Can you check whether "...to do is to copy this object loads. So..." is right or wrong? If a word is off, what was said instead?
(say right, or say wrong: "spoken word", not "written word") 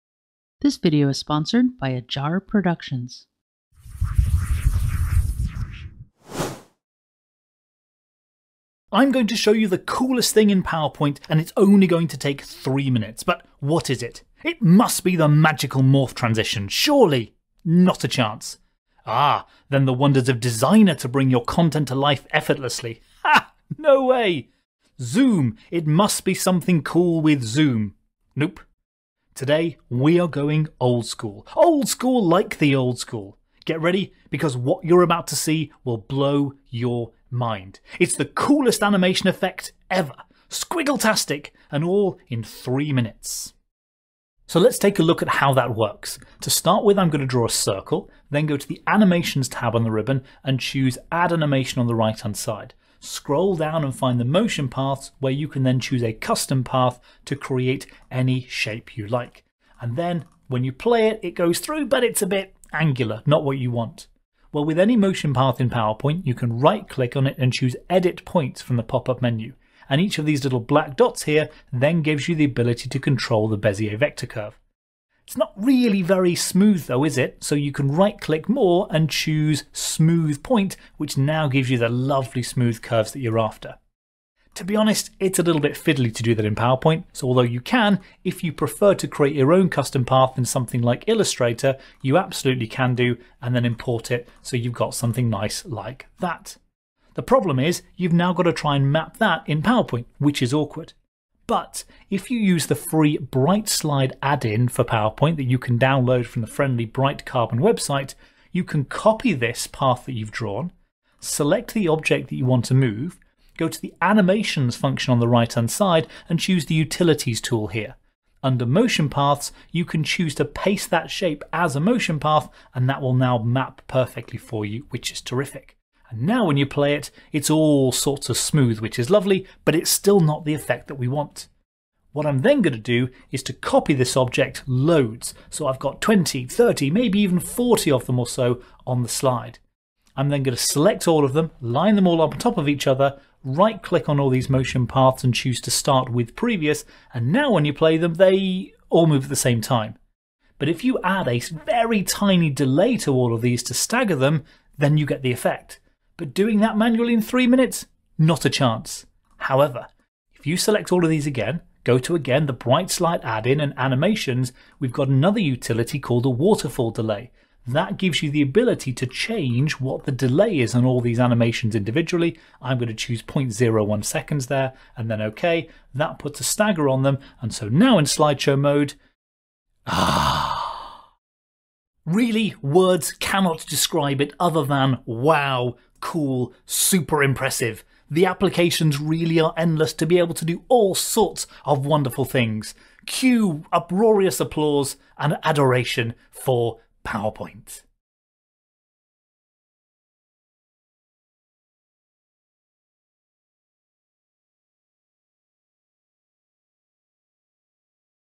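right.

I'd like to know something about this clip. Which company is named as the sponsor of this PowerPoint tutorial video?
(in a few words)
Ajar Productions.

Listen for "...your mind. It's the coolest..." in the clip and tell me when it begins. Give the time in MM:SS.
00:36.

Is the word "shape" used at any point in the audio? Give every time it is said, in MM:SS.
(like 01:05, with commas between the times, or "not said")
00:58, 02:01.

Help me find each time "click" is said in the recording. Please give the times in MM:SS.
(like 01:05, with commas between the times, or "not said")
01:06, 01:18, 02:23.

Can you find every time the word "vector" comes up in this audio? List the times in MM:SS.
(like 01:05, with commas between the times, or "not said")
01:13.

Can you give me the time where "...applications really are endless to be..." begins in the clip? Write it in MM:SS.
03:08.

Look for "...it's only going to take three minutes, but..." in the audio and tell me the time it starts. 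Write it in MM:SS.
00:11.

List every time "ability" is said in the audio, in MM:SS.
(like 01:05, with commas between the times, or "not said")
01:12, 02:48.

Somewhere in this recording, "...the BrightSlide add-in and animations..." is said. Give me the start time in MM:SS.
02:42.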